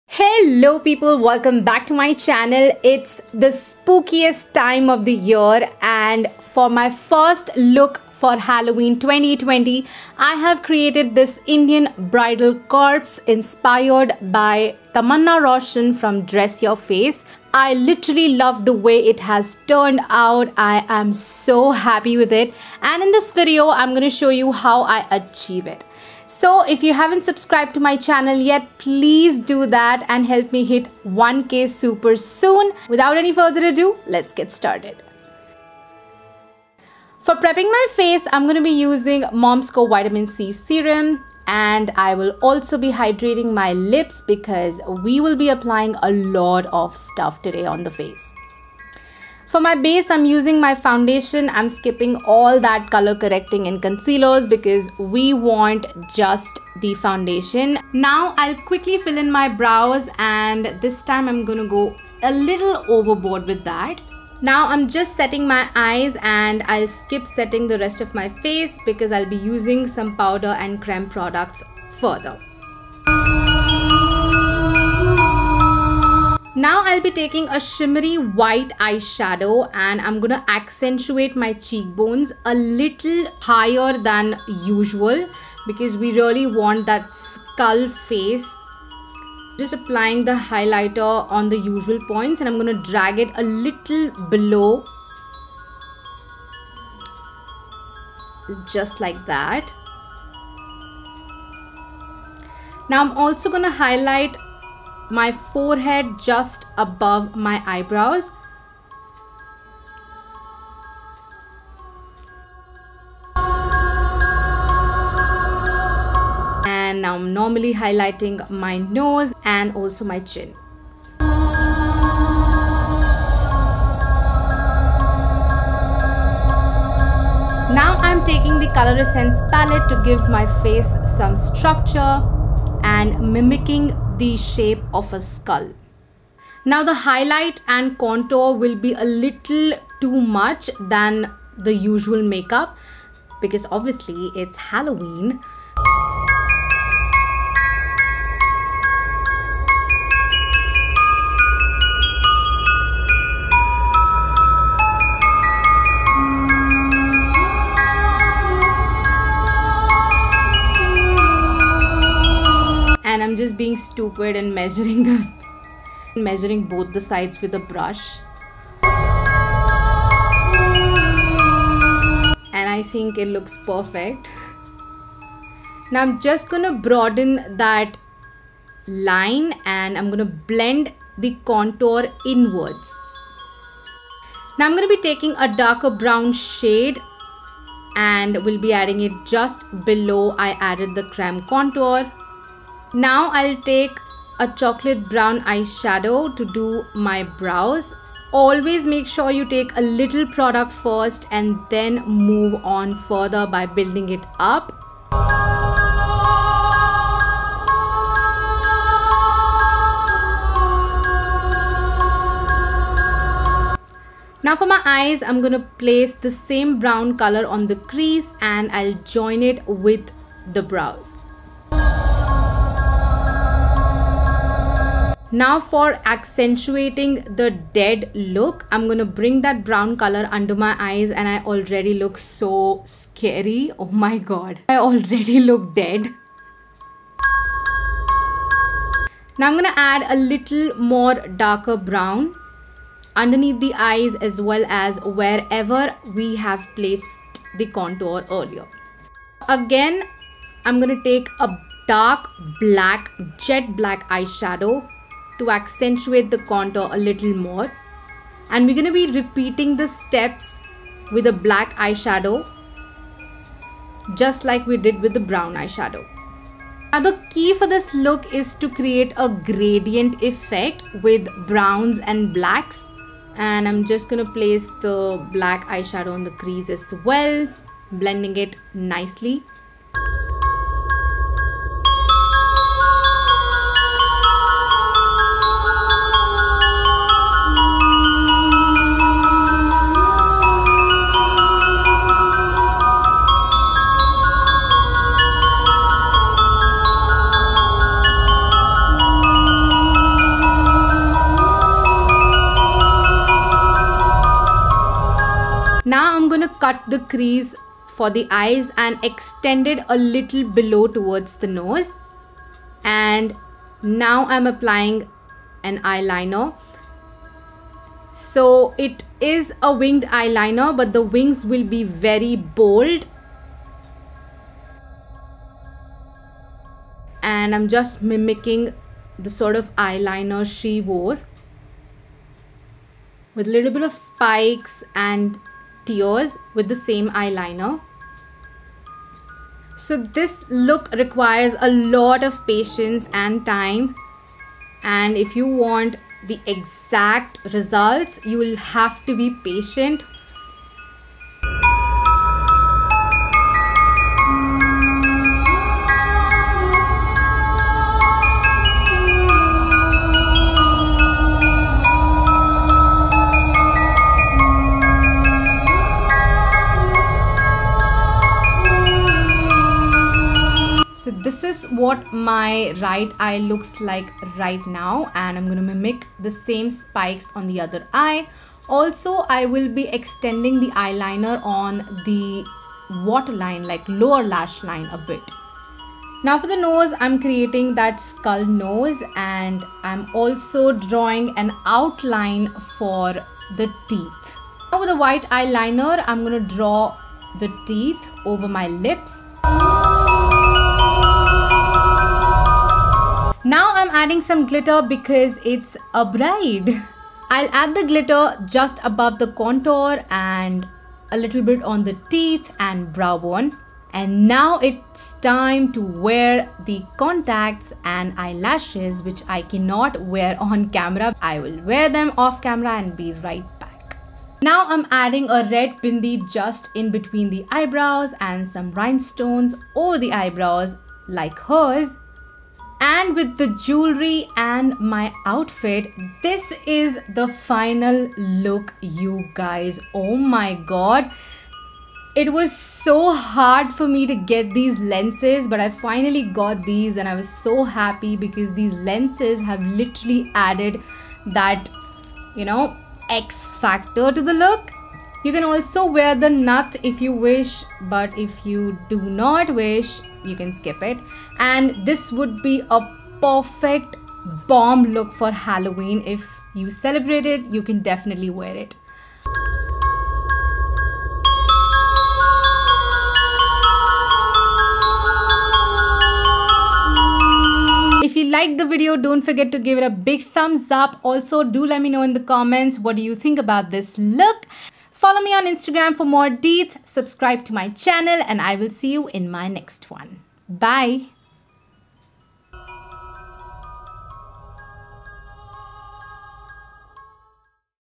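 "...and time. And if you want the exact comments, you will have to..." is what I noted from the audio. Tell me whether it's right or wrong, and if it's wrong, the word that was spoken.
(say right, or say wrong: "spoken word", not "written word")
wrong: "results", not "comments".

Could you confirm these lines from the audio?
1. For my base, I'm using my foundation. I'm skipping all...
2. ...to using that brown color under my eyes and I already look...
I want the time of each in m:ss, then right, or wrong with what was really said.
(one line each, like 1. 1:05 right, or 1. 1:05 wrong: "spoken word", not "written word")
1. 0:49 right
2. 3:48 wrong: "bring", not "using".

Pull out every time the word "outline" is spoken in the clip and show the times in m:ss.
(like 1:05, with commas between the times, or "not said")
6:31.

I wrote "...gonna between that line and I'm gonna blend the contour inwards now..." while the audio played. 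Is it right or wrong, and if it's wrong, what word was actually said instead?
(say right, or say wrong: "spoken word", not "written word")
wrong: "broaden", not "between".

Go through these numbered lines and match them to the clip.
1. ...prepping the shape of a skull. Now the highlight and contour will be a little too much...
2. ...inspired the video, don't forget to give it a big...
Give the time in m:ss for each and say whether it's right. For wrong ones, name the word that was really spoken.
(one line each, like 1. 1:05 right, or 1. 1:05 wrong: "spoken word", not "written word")
1. 2:13 wrong: "mimicking", not "prepping"
2. 7:58 wrong: "liked", not "inspired".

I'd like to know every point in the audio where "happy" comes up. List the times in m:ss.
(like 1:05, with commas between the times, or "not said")
0:21, 7:27.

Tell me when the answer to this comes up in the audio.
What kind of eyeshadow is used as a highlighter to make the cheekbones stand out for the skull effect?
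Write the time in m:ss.
1:17.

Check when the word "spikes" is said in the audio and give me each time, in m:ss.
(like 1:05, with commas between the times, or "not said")
5:33, 6:16.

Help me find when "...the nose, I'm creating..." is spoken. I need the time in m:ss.
6:26.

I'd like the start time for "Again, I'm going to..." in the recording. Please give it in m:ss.
4:09.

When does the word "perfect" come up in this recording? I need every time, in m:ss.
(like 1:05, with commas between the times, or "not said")
2:53, 7:43.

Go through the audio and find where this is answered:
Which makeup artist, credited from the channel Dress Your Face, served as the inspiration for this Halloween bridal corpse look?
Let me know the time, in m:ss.
0:14.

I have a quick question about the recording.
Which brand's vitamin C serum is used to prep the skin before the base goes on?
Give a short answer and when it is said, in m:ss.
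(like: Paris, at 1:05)
Mom's Co, at 0:39.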